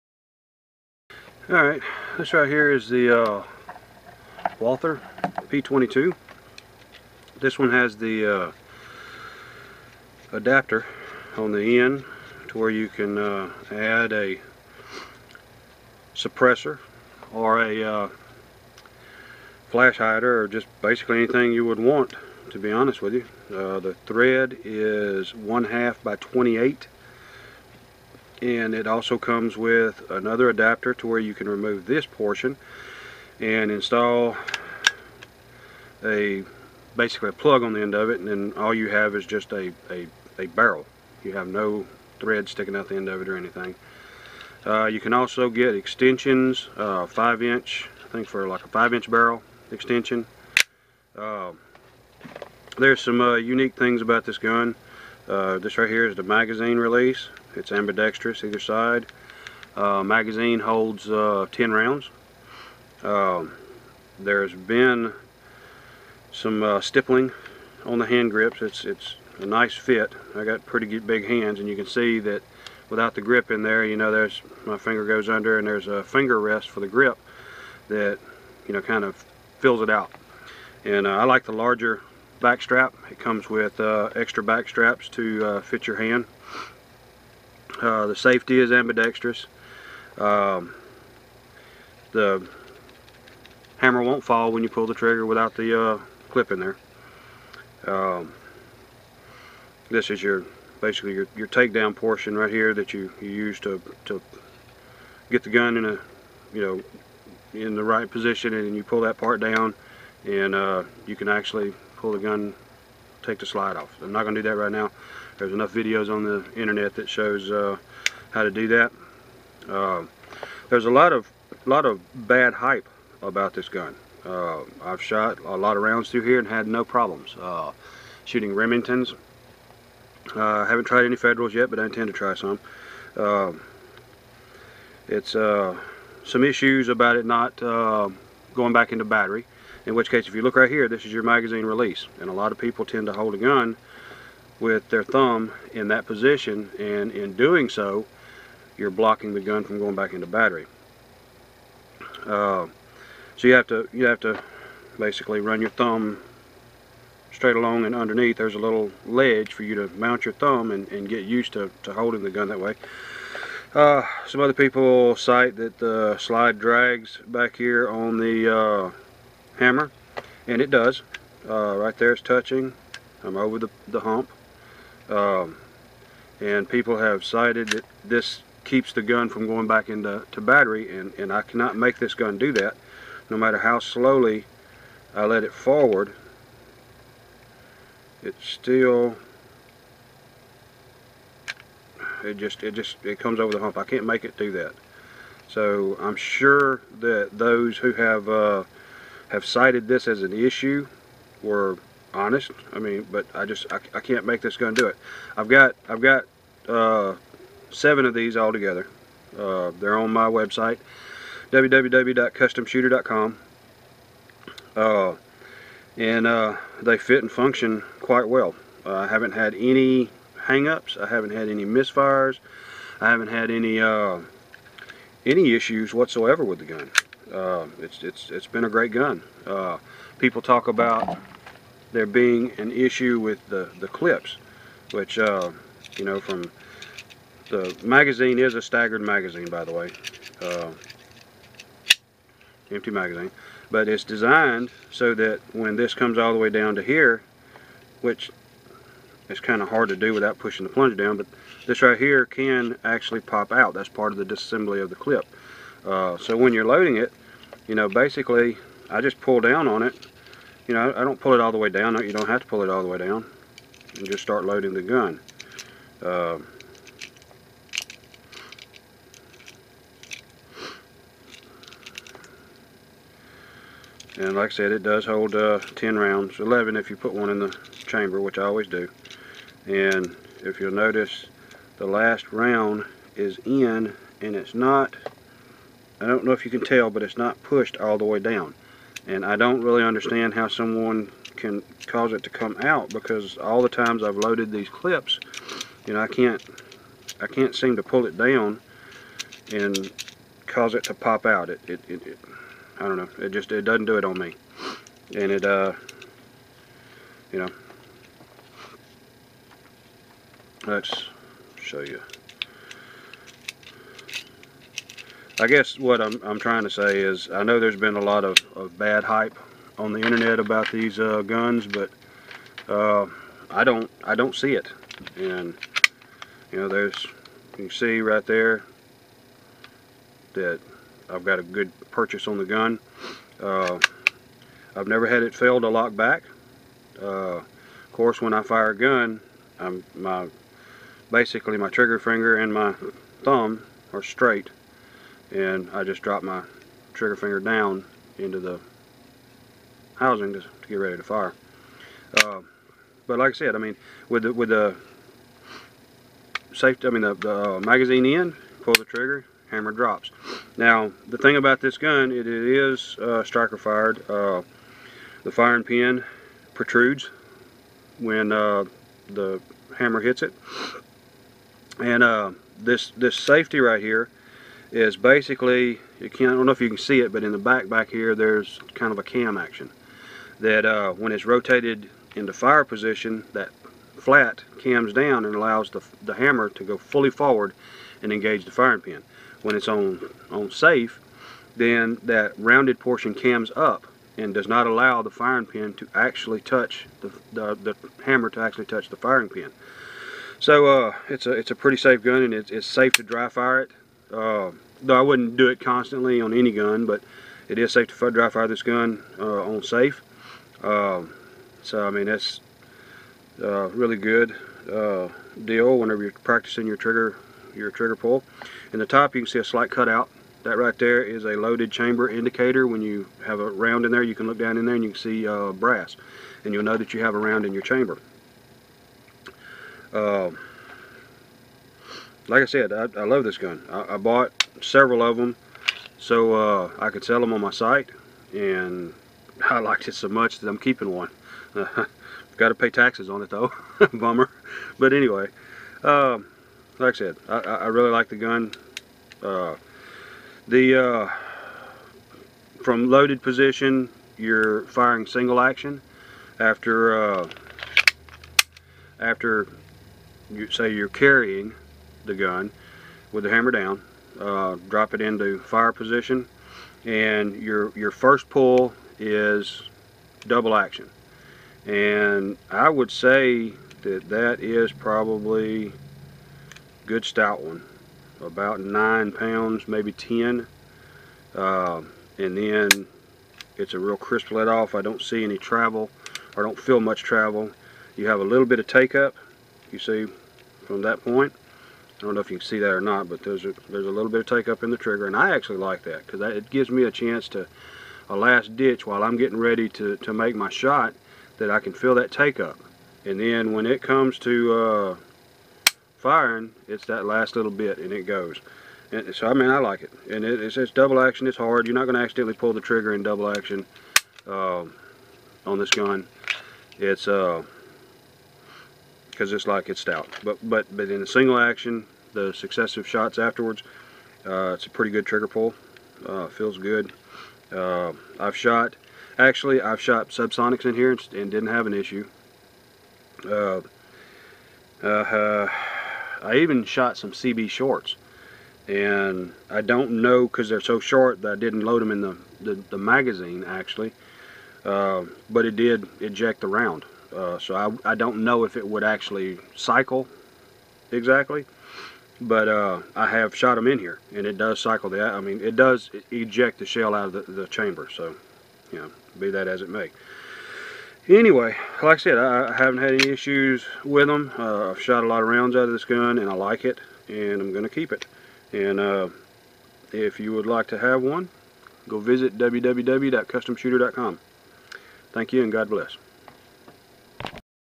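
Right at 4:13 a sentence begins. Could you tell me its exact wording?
That's part of the disassembly of the clip.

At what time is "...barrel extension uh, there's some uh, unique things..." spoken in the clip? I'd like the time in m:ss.
0:49.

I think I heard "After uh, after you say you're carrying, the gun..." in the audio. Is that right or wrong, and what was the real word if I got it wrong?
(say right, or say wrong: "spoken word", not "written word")
right.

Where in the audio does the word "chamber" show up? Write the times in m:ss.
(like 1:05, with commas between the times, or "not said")
4:37, 7:01, 7:07, 9:17.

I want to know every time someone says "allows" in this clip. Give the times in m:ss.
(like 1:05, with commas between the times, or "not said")
6:25, 6:34.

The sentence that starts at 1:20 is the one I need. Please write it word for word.
And uh, I like the larger back strap.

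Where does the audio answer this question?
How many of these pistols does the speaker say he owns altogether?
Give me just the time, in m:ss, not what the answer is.
3:27.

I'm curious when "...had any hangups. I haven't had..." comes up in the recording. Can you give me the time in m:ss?
3:39.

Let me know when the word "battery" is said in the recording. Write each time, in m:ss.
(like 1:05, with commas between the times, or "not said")
2:19, 2:30, 3:00.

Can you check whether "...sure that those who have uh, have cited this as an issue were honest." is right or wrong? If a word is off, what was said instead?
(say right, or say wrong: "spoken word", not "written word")
right.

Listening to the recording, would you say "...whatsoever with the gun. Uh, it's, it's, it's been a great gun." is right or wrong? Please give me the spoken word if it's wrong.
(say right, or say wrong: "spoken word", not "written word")
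right.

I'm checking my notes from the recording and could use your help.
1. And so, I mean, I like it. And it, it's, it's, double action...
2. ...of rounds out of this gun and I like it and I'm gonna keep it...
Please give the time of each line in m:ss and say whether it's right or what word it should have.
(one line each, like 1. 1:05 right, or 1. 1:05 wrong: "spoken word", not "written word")
1. 8:28 right
2. 9:25 right.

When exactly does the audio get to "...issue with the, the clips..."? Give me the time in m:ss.
3:52.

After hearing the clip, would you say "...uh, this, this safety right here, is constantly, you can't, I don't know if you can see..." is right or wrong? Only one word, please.
wrong.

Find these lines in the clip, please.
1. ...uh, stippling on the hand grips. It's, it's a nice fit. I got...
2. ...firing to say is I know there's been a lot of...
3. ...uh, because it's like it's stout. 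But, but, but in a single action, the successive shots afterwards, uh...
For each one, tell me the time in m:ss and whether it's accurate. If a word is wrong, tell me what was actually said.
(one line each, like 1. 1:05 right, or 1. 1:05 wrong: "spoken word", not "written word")
1. 1:06 right
2. 5:16 wrong: "trying", not "firing"
3. 8:37 right.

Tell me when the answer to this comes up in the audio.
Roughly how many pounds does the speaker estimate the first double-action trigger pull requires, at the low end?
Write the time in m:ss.
7:58.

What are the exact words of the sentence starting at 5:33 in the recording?
Uh, I've never had it fail to lock back.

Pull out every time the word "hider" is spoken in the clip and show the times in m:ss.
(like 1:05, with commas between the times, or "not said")
0:19.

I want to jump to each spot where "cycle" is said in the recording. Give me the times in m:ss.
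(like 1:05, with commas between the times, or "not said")
9:09, 9:14.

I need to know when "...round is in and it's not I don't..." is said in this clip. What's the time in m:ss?
4:42.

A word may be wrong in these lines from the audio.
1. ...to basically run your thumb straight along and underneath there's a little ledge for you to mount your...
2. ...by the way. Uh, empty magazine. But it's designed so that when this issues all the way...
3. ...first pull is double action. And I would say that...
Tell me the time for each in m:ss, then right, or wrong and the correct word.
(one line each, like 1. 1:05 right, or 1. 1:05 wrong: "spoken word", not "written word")
1. 2:34 right
2. 3:59 wrong: "comes", not "issues"
3. 7:47 right.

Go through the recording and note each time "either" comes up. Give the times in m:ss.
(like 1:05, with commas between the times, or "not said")
0:58.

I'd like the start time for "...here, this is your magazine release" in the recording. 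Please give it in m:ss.
2:20.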